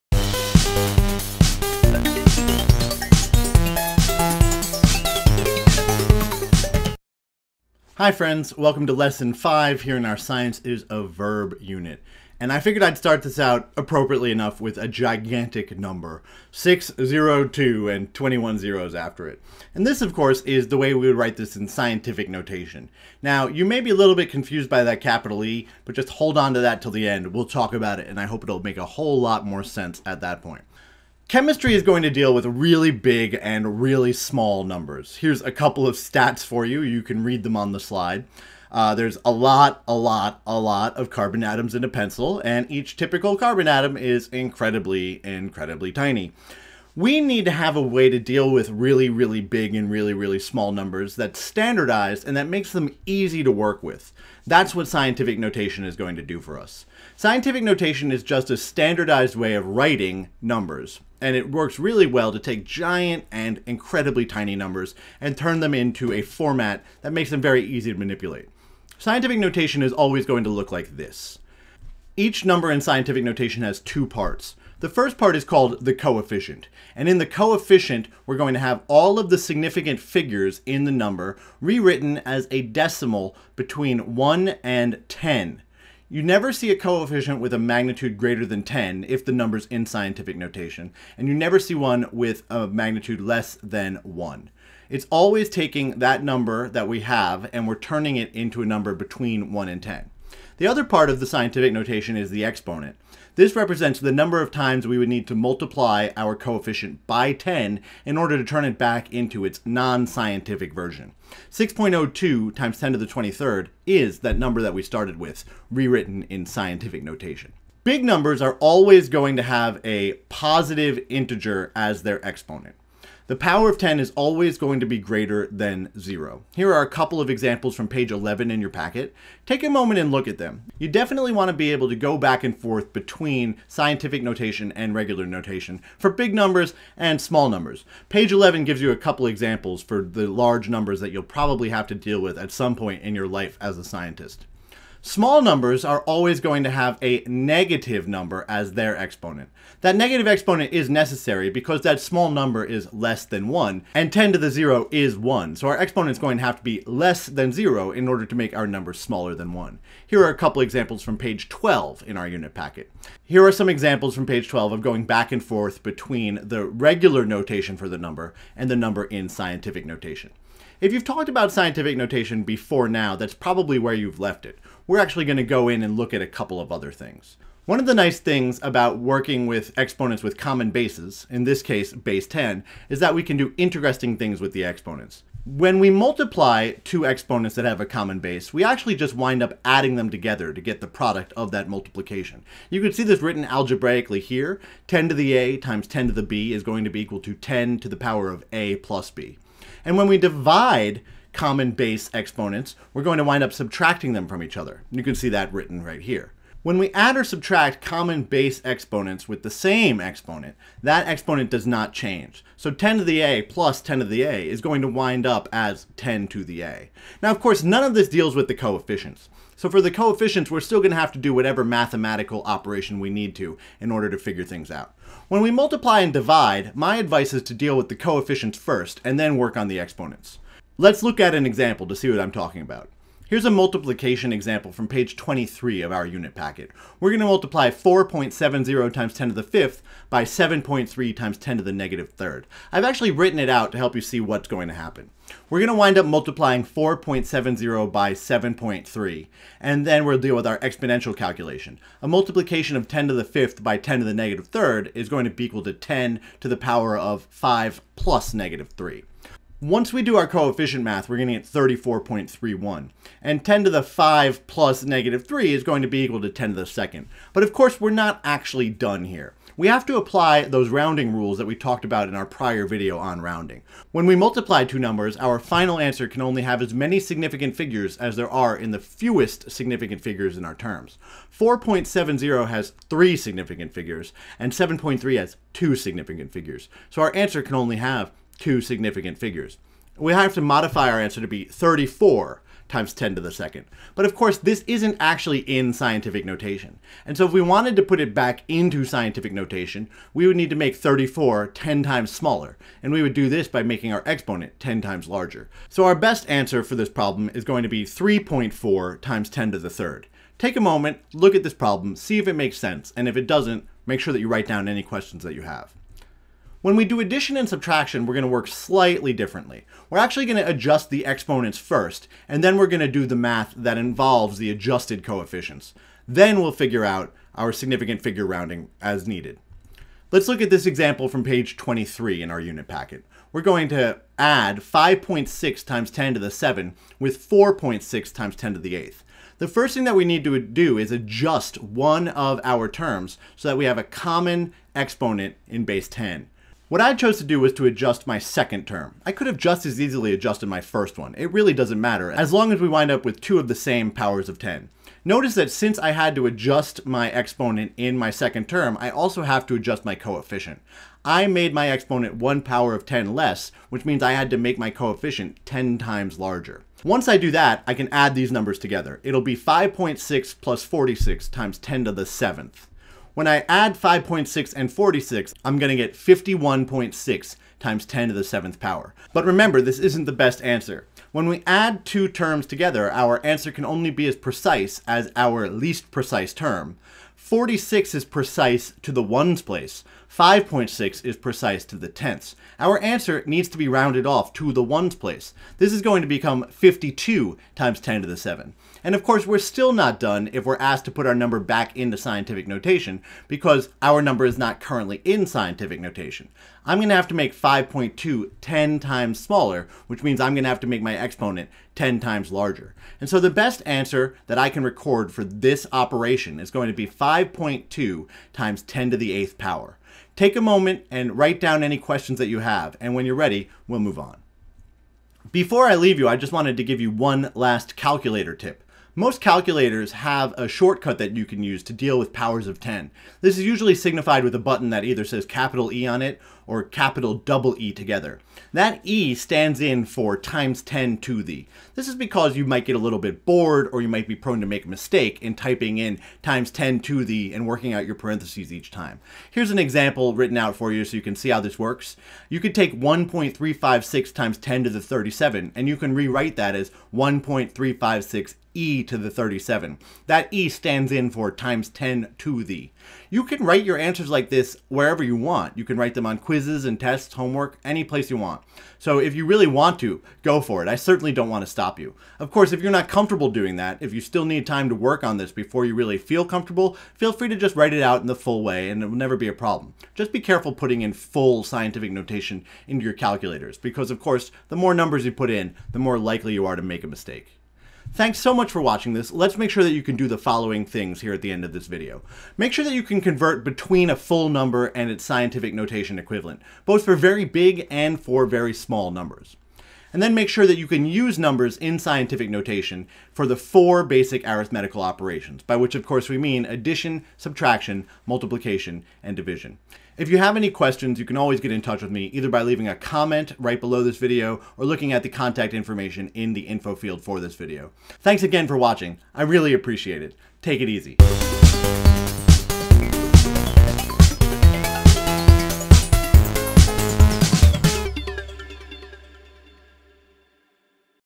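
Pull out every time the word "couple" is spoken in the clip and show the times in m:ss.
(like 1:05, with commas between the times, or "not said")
0:35, 2:06, 2:18, 2:40, 2:56.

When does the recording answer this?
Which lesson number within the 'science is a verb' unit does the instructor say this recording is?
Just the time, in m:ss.
0:08.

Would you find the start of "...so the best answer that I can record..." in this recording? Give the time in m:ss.
6:53.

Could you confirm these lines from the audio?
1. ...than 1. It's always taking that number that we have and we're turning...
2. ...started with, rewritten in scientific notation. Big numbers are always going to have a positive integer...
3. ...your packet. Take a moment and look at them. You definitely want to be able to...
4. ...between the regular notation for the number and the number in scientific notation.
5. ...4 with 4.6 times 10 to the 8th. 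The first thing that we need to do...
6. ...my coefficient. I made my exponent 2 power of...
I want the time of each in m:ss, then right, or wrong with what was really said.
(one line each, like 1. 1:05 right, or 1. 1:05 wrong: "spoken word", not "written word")
1. 1:33 right
2. 1:54 right
3. 2:08 right
4. 2:45 right
5. 5:36 wrong: "7", not "4"
6. 5:59 wrong: "1", not "2".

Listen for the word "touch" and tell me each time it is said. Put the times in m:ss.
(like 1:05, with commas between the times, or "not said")
8:31.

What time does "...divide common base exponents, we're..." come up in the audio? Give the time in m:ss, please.
3:20.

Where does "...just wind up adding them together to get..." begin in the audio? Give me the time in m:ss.
3:08.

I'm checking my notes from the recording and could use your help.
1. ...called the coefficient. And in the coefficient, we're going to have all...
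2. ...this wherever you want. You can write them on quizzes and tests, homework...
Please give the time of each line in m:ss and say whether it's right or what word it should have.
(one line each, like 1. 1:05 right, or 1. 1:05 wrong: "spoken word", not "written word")
1. 1:15 right
2. 7:44 right.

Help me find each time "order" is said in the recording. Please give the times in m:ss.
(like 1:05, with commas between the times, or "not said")
1:48, 2:38, 3:43.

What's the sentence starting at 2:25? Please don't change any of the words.
Small numbers are always going to have a negative number as their exponent.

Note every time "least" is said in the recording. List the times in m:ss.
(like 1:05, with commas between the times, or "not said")
6:25.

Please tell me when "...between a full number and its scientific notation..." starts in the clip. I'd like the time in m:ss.
8:13.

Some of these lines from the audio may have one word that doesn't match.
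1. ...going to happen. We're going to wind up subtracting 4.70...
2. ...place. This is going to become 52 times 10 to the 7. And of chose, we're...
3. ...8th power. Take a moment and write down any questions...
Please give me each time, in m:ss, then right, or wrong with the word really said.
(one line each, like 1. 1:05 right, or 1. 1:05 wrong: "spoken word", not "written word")
1. 4:04 wrong: "multiplying", not "subtracting"
2. 6:34 wrong: "course", not "chose"
3. 6:59 right.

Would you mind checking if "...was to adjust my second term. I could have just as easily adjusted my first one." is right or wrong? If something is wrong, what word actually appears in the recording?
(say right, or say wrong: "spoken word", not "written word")
right.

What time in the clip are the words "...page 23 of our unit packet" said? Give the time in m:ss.
3:54.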